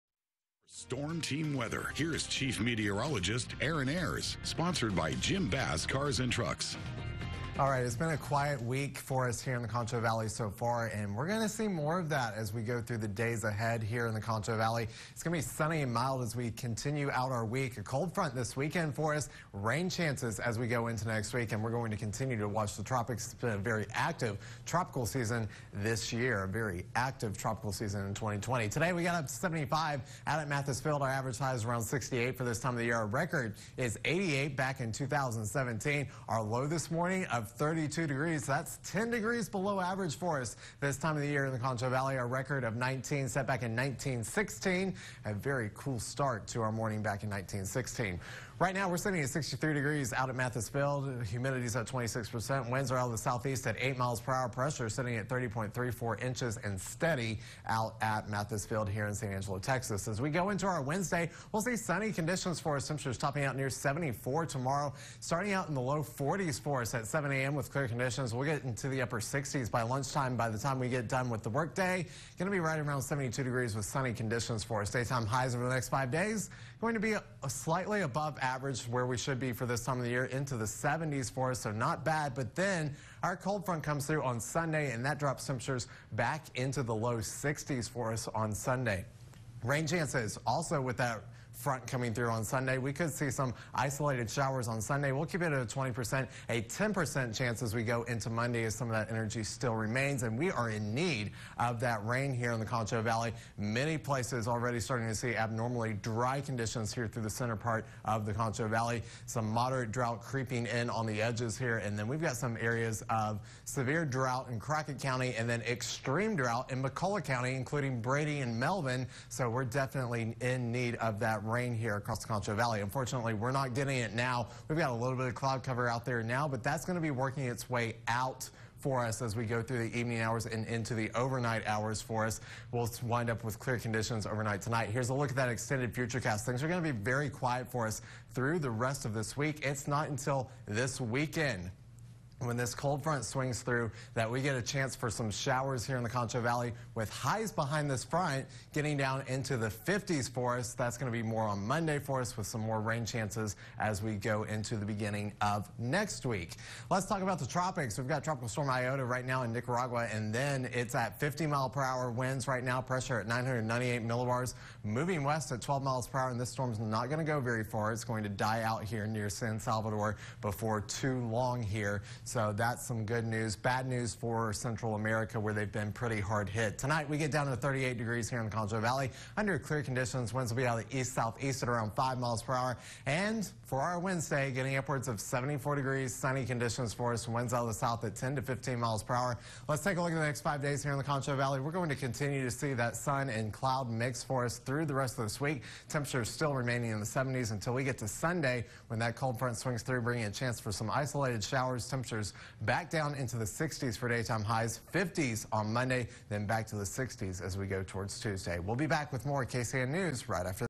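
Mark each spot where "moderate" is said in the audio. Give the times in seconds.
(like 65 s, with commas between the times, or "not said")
109 s.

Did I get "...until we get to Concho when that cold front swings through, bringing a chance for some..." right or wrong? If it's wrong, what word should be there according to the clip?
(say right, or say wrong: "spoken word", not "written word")
wrong: "Sunday", not "Concho".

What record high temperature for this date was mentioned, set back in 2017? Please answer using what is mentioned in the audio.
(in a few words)
88.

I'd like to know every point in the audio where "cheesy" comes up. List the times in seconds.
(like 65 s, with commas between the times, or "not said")
not said.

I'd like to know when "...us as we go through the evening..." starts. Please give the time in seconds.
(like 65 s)
129 s.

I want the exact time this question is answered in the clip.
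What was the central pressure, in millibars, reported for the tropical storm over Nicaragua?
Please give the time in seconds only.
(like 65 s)
163 s.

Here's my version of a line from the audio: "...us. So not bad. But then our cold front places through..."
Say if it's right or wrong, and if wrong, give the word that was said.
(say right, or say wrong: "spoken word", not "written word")
wrong: "comes", not "places".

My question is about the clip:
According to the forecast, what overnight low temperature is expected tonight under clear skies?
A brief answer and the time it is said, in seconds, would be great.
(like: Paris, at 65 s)
38 degrees, at 177 s.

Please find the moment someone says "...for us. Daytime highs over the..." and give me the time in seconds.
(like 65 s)
74 s.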